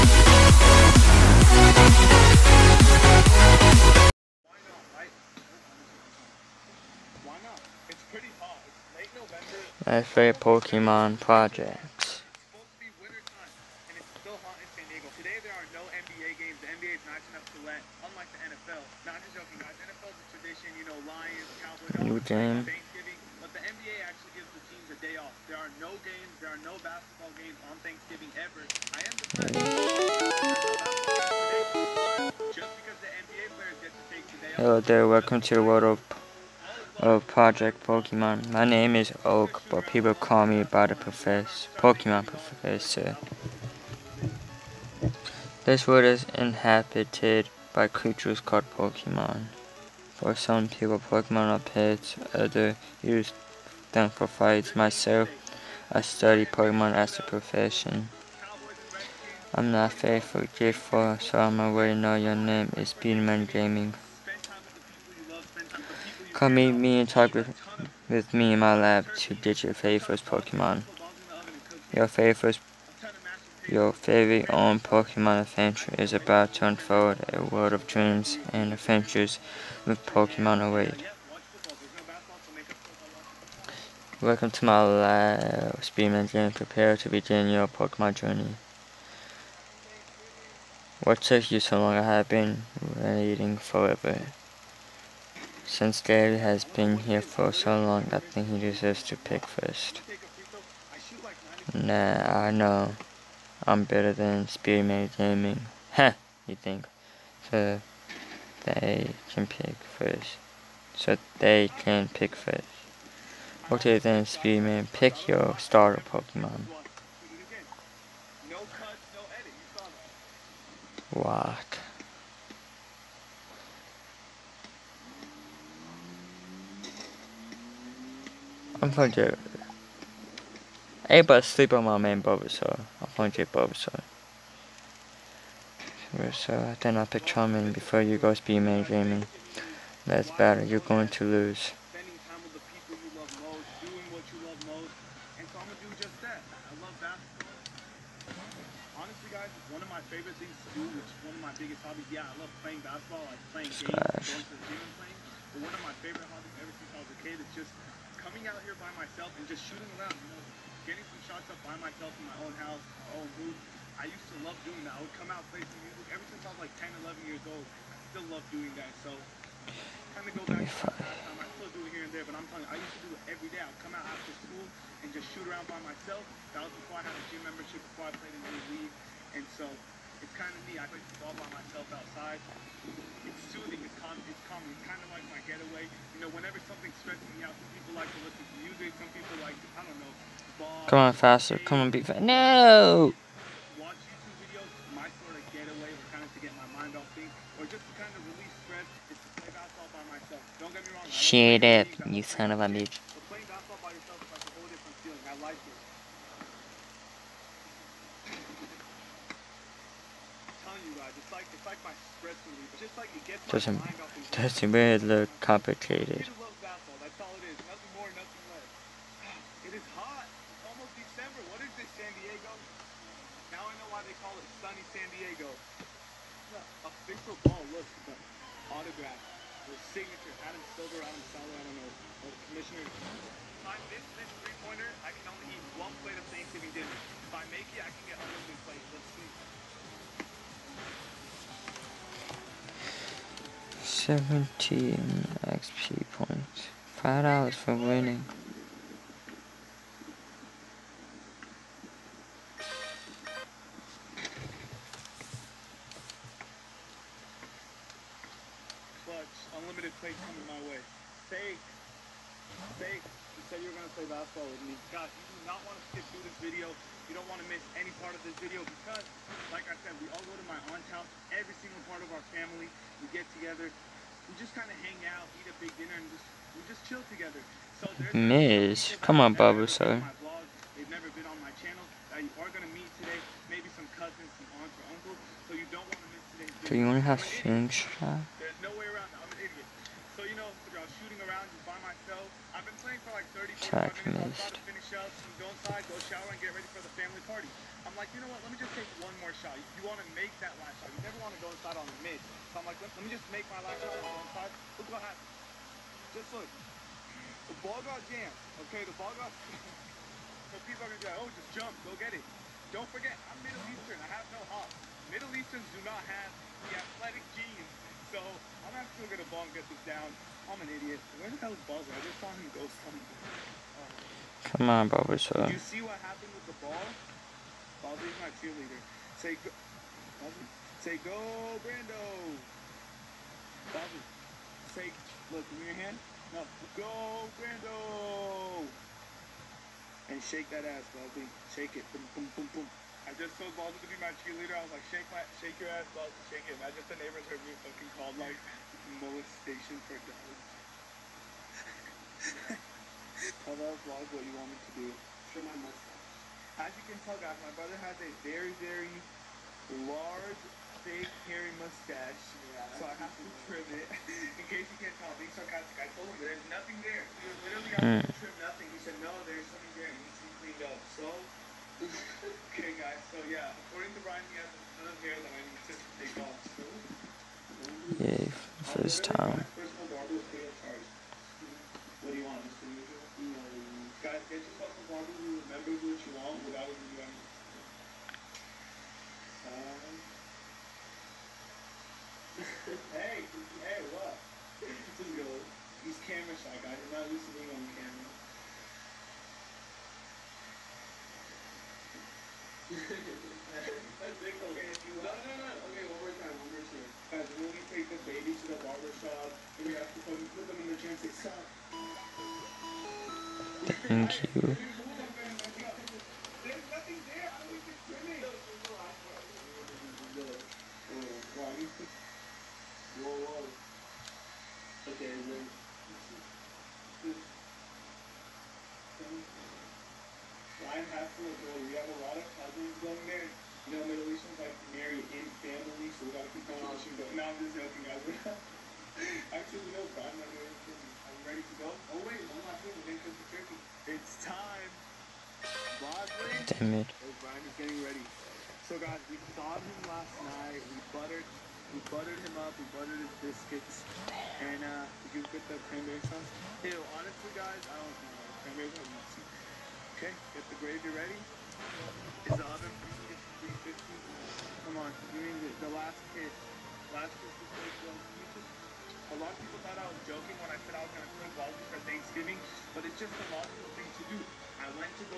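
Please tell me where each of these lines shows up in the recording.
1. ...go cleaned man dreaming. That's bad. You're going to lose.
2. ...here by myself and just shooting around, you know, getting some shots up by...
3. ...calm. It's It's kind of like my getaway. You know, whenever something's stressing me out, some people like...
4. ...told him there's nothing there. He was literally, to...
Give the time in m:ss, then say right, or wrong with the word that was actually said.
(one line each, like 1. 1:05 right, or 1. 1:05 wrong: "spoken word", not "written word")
1. 2:18 wrong: "speed", not "cleaned"
2. 2:38 right
3. 3:04 right
4. 6:05 right.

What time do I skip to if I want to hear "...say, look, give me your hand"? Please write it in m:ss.
5:34.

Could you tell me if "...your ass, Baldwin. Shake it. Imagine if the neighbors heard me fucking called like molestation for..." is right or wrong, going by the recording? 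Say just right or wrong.
right.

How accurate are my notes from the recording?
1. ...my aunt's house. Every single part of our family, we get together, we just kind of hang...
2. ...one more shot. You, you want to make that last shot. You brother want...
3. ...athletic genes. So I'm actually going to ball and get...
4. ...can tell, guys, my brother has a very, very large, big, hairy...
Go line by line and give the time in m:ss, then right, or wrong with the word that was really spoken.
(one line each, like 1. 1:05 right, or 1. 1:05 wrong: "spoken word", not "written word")
1. 4:30 right
2. 4:58 wrong: "never", not "brother"
3. 5:16 right
4. 5:56 right.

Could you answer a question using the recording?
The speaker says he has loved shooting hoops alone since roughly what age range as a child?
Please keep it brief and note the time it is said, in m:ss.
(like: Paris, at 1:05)
10, 11, at 2:46.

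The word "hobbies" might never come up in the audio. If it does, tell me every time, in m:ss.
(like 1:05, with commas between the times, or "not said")
2:31, 2:36.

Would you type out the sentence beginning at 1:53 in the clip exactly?
Okay then Spearman, pick your starter Pokemon.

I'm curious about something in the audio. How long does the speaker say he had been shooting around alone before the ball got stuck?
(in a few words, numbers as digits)
30 minutes.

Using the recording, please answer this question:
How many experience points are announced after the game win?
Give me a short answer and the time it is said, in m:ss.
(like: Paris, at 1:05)
17, at 4:04.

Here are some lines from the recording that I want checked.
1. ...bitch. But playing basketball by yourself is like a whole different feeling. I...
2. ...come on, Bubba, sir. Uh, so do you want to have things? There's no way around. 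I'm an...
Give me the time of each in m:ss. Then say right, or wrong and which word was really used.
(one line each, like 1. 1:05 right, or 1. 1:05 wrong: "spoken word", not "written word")
1. 3:22 right
2. 4:39 right.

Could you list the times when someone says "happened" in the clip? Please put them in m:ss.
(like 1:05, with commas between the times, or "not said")
5:04, 5:26.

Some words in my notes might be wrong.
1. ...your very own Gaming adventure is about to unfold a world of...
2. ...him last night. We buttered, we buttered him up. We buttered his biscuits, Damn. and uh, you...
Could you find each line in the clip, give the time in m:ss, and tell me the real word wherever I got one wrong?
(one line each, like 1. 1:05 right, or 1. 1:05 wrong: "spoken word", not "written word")
1. 1:13 wrong: "Pokemon", not "Gaming"
2. 7:29 right.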